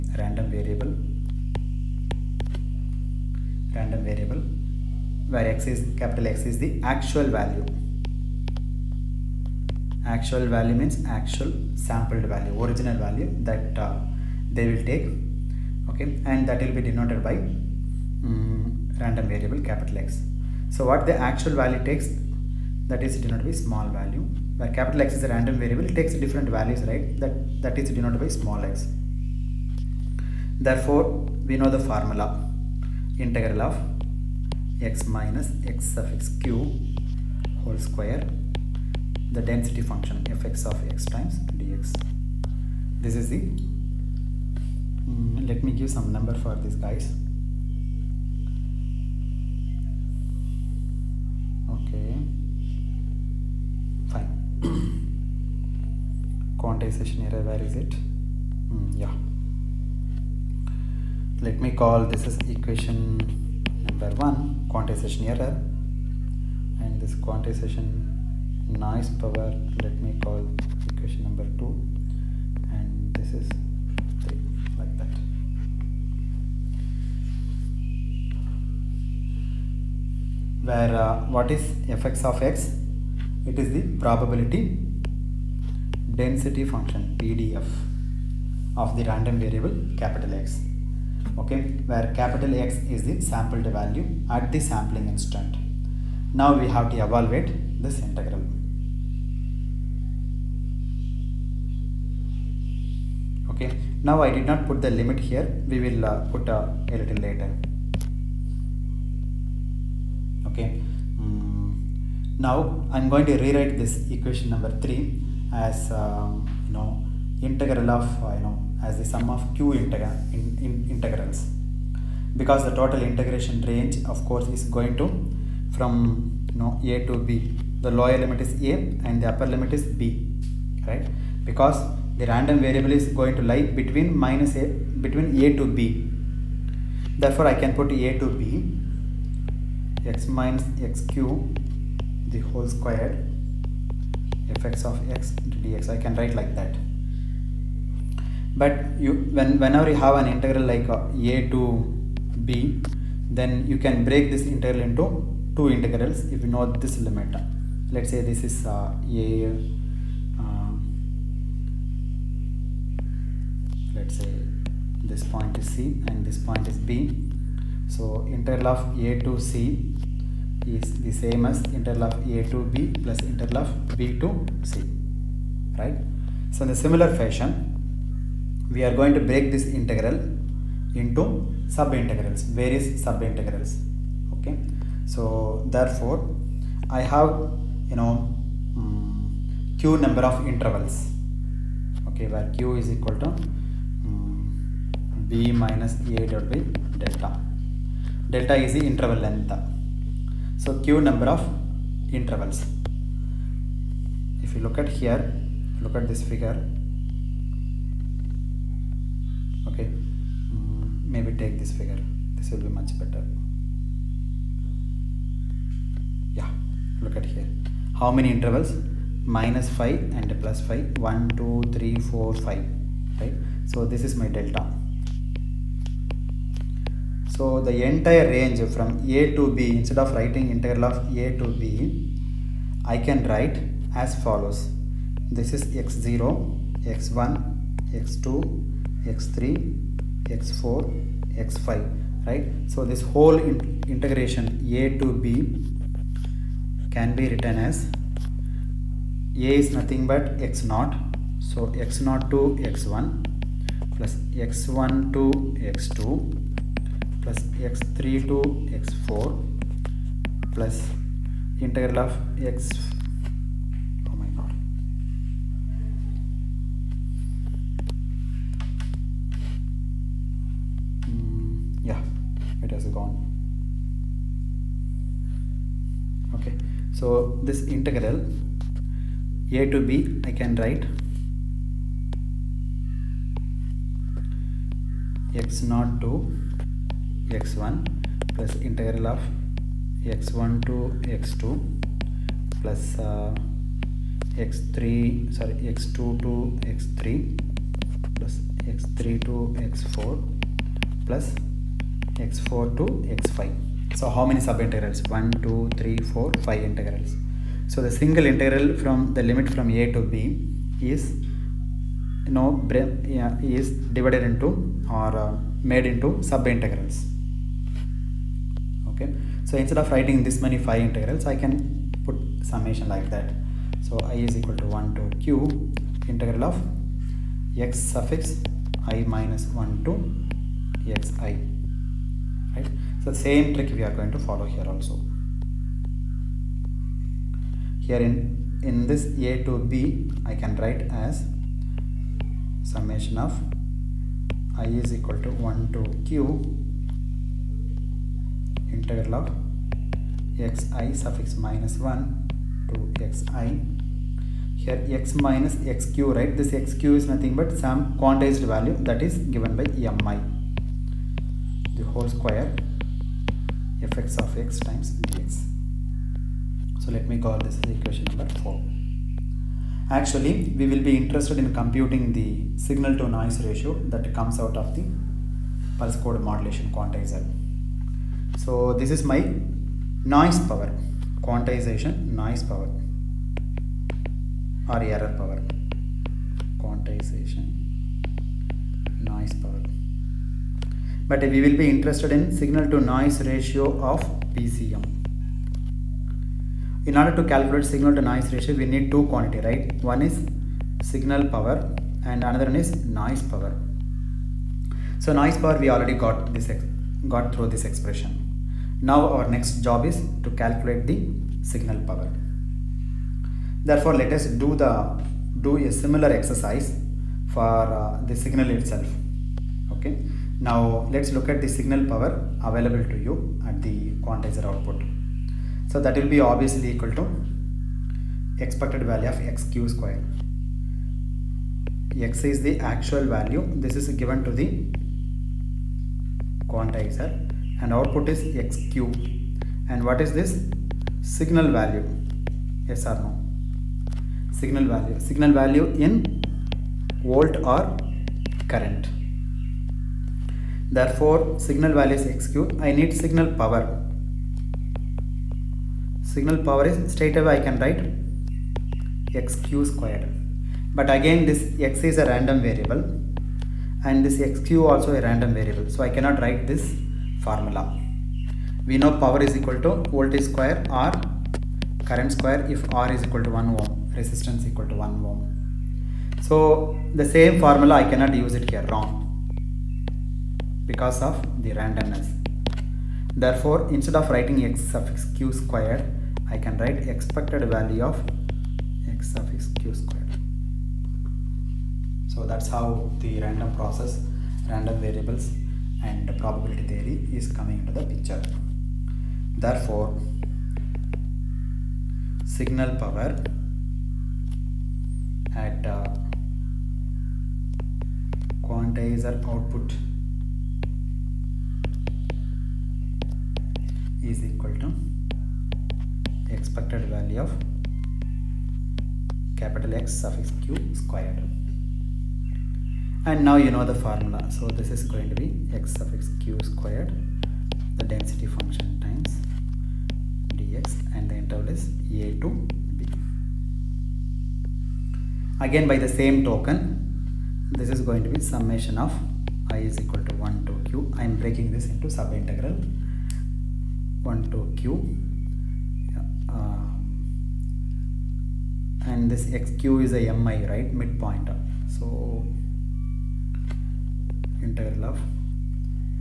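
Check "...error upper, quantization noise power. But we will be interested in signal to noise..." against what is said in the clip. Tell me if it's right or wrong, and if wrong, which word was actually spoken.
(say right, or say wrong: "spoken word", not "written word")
wrong: "power", not "upper".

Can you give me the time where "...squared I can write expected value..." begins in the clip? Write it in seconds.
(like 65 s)
485 s.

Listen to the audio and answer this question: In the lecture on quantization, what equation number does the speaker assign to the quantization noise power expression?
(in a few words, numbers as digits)
2.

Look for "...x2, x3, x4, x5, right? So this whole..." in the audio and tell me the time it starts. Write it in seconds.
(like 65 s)
237 s.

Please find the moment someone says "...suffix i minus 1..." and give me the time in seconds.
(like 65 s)
327 s.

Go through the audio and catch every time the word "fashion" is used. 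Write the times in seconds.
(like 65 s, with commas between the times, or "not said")
177 s.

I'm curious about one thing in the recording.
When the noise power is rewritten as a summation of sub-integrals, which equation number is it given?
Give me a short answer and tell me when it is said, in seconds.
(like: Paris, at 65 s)
4, at 367 s.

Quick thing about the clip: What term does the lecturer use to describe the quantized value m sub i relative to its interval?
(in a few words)
midpoint.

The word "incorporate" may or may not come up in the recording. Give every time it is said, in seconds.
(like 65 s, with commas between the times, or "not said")
not said.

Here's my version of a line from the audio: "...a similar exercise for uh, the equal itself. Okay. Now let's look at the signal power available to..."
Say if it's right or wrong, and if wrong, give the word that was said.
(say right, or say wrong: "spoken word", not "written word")
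wrong: "signal", not "equal".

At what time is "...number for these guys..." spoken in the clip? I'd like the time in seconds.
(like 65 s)
46 s.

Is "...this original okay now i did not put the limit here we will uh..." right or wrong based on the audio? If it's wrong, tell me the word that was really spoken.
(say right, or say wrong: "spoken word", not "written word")
wrong: "integral", not "original".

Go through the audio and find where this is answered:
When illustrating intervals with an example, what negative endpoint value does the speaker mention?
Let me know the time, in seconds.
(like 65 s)
219 s.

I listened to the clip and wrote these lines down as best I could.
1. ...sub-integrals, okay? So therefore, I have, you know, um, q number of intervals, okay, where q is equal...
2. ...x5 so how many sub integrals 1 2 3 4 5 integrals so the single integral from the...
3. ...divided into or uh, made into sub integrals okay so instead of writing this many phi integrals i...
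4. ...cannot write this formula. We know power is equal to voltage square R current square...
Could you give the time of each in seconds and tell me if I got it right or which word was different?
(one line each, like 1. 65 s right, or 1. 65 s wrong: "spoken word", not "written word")
1. 183 s right
2. 303 s right
3. 313 s right
4. 465 s right.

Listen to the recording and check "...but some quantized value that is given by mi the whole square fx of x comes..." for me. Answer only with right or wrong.
wrong.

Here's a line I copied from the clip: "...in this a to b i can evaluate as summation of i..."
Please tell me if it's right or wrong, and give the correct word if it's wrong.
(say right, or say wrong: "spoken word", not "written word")
wrong: "write", not "evaluate".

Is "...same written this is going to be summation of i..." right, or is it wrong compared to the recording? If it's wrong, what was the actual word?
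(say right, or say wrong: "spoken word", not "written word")
wrong: "token", not "written".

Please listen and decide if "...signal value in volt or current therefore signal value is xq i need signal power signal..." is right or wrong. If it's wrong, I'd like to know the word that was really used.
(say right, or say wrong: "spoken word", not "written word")
right.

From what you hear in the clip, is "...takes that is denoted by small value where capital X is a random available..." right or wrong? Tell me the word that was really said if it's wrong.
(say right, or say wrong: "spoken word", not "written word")
wrong: "variable", not "available".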